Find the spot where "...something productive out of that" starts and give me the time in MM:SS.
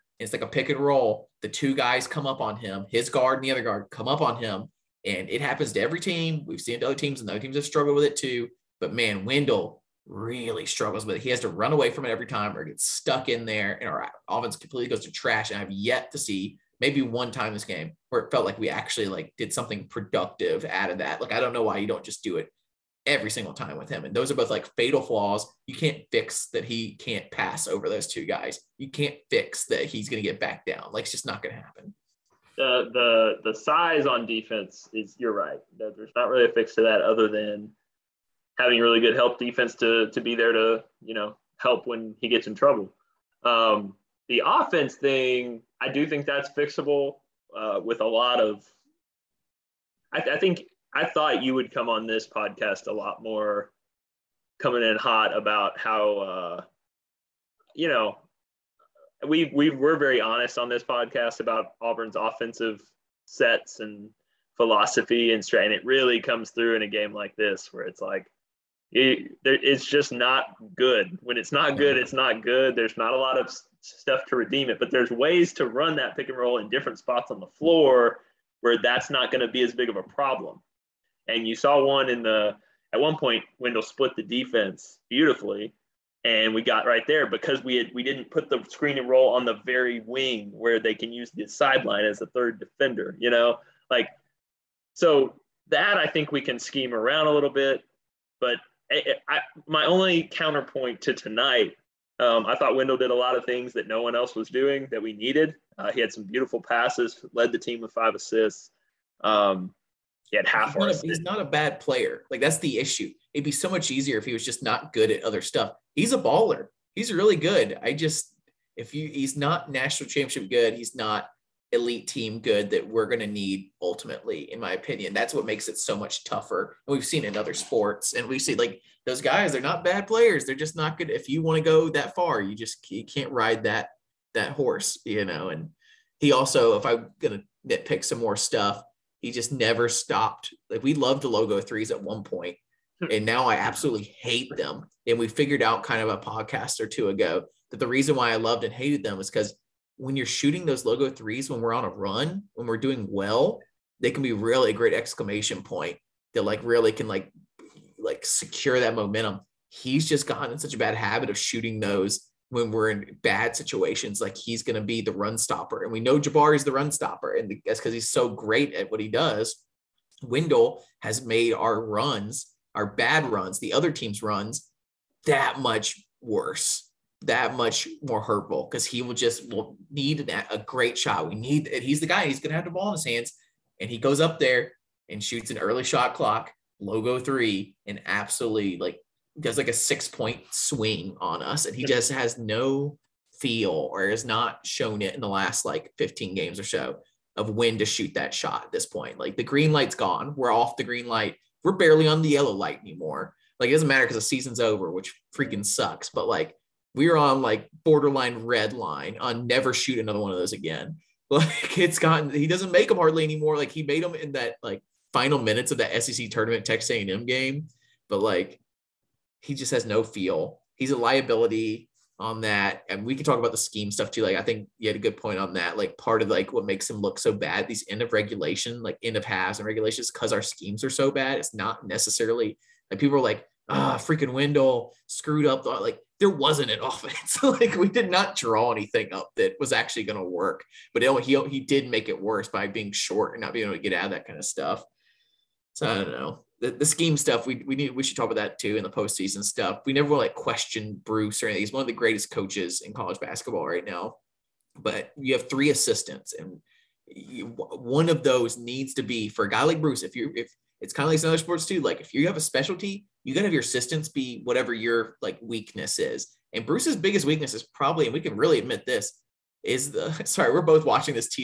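00:19.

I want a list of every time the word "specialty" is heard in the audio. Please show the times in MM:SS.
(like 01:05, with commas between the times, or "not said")
04:22.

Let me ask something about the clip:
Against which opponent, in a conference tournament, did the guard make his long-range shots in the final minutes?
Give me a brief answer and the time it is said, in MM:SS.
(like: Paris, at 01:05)
Texas A&M, at 03:36.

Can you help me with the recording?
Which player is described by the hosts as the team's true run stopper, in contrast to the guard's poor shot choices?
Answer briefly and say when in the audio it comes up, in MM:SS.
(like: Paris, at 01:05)
Jabari, at 02:46.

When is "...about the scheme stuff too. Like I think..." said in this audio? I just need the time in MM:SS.
03:43.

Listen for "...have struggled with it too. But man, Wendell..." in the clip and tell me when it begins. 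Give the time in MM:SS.
00:07.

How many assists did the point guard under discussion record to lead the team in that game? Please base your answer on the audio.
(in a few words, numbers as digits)
5.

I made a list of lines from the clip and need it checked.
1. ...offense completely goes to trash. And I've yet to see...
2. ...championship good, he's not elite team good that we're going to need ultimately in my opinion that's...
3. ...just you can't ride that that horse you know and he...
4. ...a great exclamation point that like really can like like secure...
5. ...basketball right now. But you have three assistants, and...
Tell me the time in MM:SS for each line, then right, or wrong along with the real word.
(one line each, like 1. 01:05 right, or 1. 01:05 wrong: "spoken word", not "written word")
1. 00:14 right
2. 02:00 right
3. 02:12 right
4. 02:34 right
5. 04:13 right.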